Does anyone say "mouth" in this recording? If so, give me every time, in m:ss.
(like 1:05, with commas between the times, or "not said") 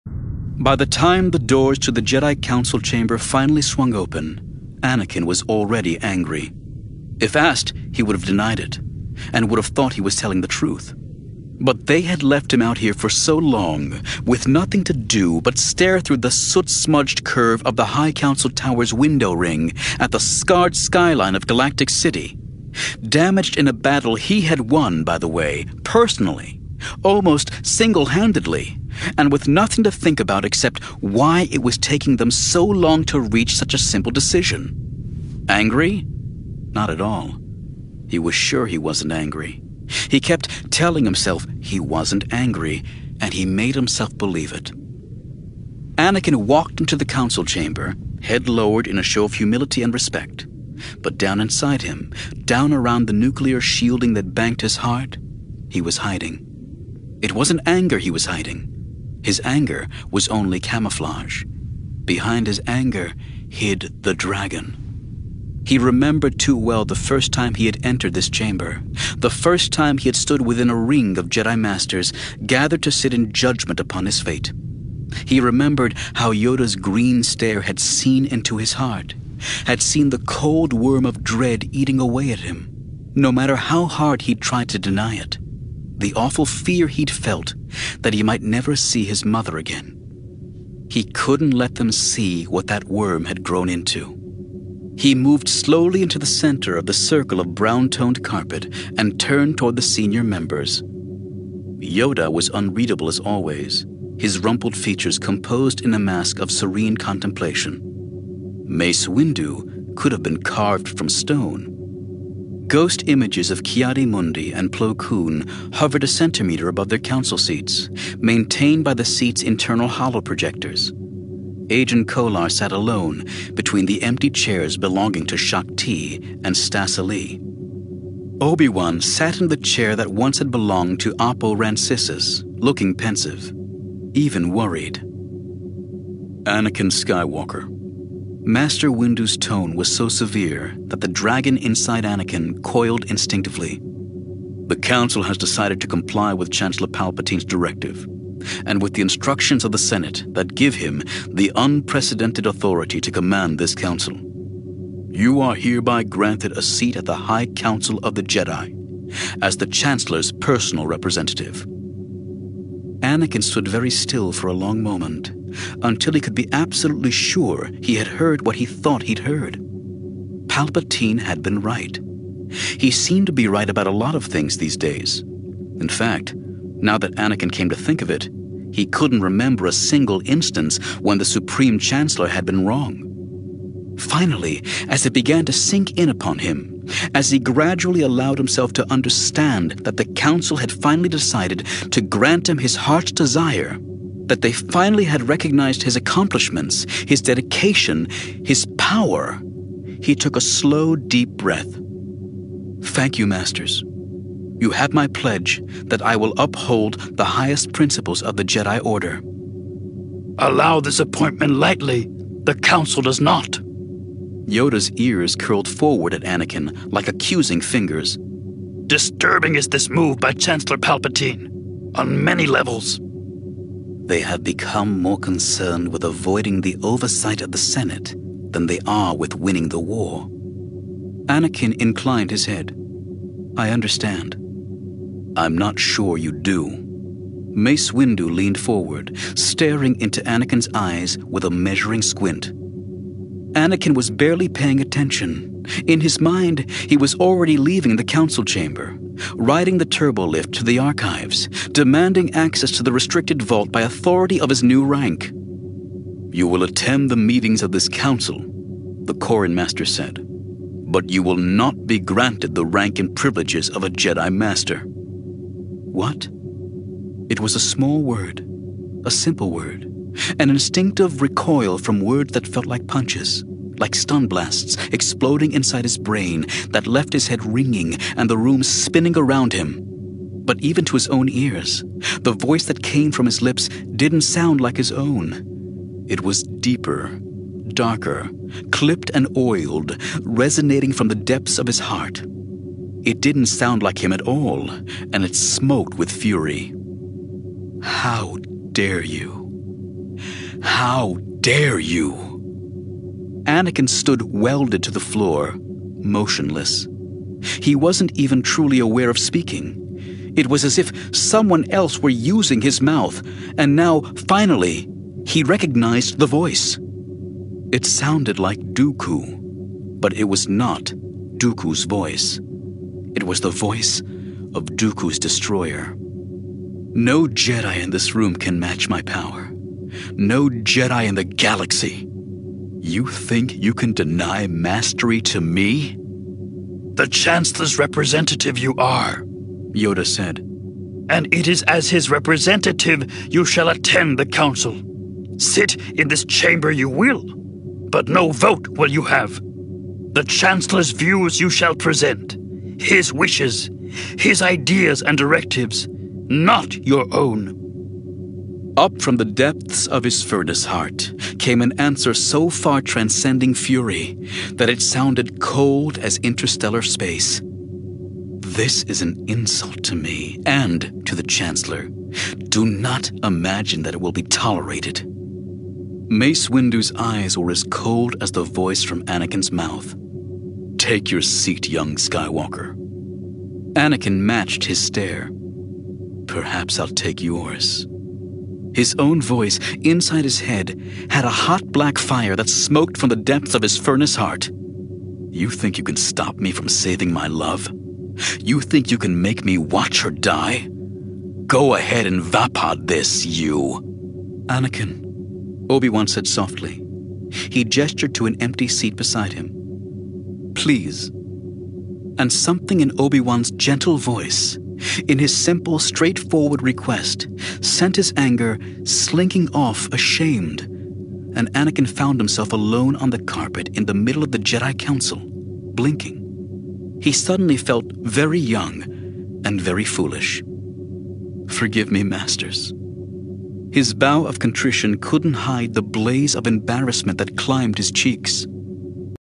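5:12, 6:19.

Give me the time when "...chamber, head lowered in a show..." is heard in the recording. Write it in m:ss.
0:47.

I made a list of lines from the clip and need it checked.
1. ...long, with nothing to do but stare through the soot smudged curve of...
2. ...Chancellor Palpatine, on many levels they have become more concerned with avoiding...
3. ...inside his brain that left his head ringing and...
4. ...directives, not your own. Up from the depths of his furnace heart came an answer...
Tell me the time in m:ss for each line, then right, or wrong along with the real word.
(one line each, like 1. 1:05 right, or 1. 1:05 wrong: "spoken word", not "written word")
1. 0:13 right
2. 3:40 right
3. 4:35 right
4. 5:55 right.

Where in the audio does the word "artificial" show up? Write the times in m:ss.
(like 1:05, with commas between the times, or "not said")
not said.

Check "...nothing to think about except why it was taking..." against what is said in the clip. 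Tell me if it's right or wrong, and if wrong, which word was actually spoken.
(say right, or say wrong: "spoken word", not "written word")
right.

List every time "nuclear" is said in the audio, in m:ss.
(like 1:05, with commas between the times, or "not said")
0:53.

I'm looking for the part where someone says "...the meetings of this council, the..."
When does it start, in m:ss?
4:17.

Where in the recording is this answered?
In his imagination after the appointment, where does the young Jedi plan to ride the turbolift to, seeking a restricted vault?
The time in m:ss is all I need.
4:10.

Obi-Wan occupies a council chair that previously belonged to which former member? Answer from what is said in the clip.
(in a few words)
Oppo Rancisis.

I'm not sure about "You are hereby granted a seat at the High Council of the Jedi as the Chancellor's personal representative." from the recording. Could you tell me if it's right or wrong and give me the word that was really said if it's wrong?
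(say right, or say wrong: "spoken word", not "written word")
right.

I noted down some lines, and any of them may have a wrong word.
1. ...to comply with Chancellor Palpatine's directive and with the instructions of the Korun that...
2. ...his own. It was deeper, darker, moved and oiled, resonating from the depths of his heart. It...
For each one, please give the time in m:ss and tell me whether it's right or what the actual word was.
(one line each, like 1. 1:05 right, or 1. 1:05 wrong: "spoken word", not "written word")
1. 2:25 wrong: "Senate", not "Korun"
2. 4:44 wrong: "clipped", not "moved".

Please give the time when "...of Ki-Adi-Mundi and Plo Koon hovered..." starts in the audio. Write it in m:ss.
1:53.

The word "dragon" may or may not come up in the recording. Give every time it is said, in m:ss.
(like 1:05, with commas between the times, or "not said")
1:04, 2:21.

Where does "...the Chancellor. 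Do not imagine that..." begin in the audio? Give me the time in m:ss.
6:11.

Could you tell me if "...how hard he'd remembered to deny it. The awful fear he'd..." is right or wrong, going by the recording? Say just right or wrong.
wrong.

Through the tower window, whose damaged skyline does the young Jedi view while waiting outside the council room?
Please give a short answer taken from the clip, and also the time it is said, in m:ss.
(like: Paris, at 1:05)
Galactic City, at 0:21.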